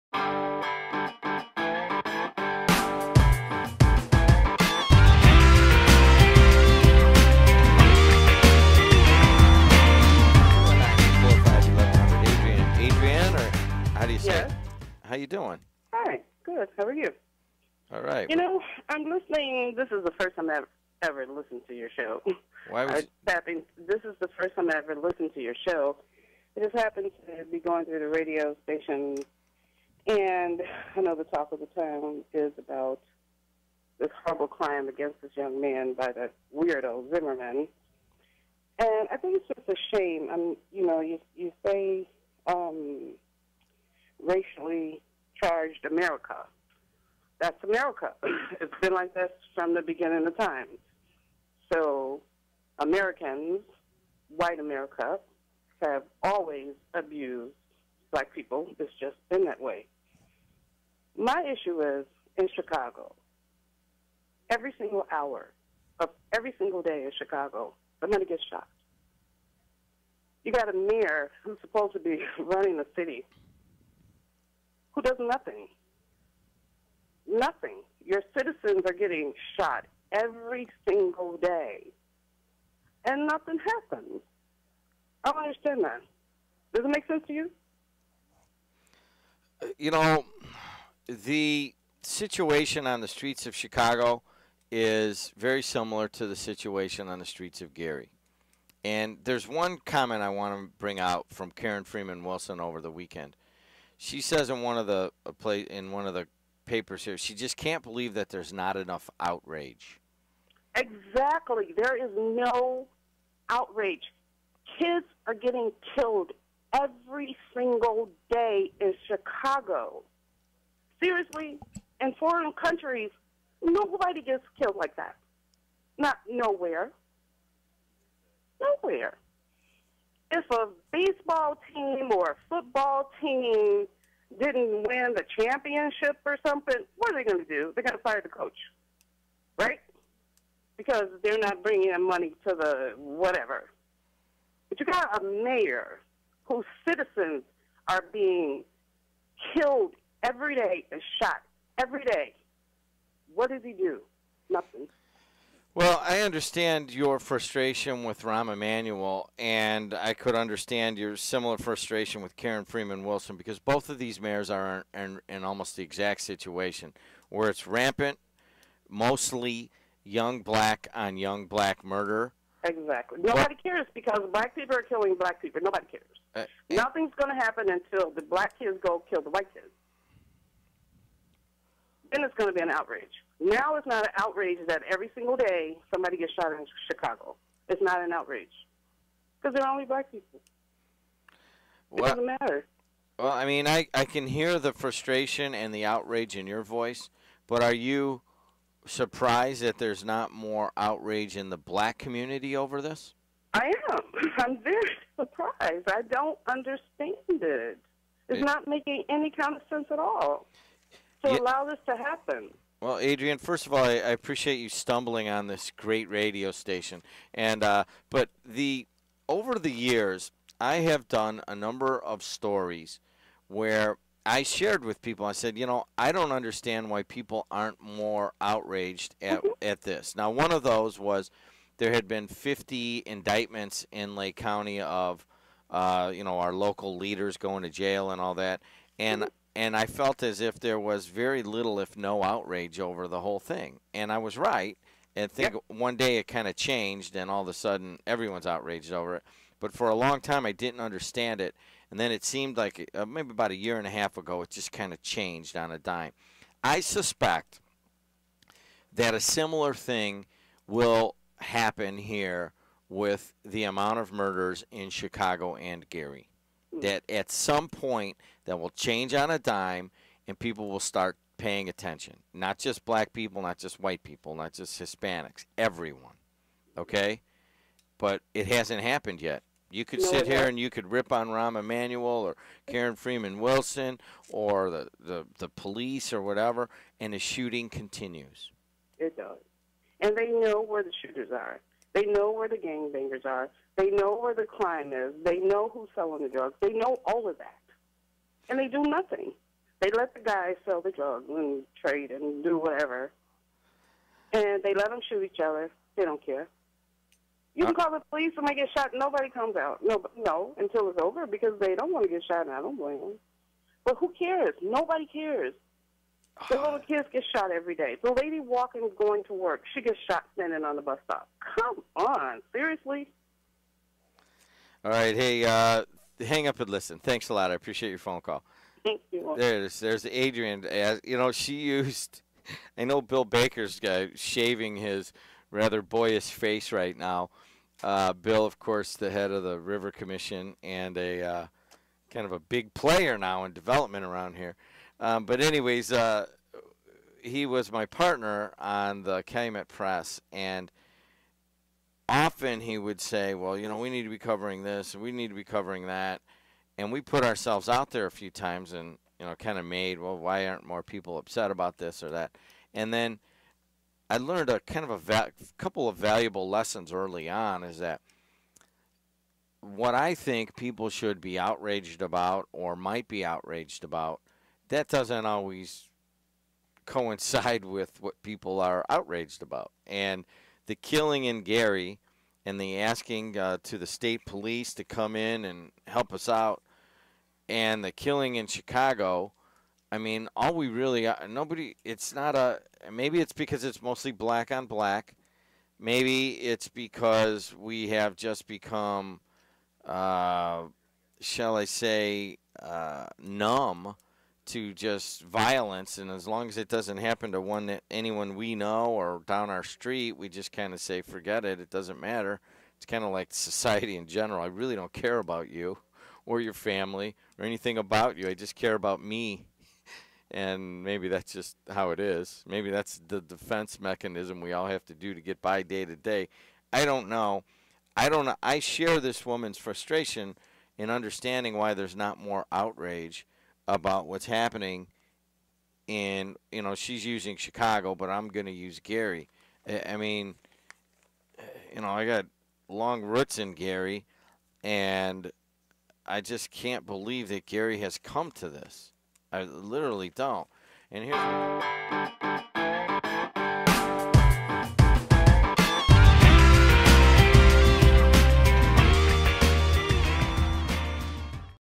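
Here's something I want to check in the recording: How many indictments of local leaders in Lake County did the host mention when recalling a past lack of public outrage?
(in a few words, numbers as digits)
50.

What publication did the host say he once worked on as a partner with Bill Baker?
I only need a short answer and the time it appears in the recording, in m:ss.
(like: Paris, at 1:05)
Calumet Press, at 5:49.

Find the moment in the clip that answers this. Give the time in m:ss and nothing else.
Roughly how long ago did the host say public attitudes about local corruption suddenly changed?
4:13.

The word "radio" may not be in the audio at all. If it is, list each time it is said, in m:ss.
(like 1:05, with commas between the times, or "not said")
0:28, 3:36.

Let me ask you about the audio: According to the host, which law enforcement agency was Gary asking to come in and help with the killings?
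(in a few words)
state police.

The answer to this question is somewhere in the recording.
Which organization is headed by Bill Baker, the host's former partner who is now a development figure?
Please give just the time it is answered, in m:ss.
5:39.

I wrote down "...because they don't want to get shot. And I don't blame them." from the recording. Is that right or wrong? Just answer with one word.
right.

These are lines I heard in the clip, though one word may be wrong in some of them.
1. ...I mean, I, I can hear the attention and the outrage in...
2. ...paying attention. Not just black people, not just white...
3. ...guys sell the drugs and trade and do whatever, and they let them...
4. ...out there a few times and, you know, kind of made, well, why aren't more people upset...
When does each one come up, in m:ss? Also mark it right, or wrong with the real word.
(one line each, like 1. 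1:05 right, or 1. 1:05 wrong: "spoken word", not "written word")
1. 3:13 wrong: "frustration", not "attention"
2. 4:31 right
3. 5:00 right
4. 5:57 right.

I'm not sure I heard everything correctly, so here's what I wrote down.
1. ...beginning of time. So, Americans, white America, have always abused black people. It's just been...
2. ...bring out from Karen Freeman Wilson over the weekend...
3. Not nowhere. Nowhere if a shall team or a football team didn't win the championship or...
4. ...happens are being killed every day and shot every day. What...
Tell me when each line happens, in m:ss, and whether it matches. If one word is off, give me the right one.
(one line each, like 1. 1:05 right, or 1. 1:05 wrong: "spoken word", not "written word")
1. 0:49 right
2. 1:40 right
3. 2:05 wrong: "baseball", not "shall"
4. 2:26 wrong: "citizens", not "happens".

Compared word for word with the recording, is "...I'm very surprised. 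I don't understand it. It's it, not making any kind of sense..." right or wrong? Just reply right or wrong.
right.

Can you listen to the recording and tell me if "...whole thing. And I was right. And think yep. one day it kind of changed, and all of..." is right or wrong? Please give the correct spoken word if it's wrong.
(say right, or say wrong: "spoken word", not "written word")
right.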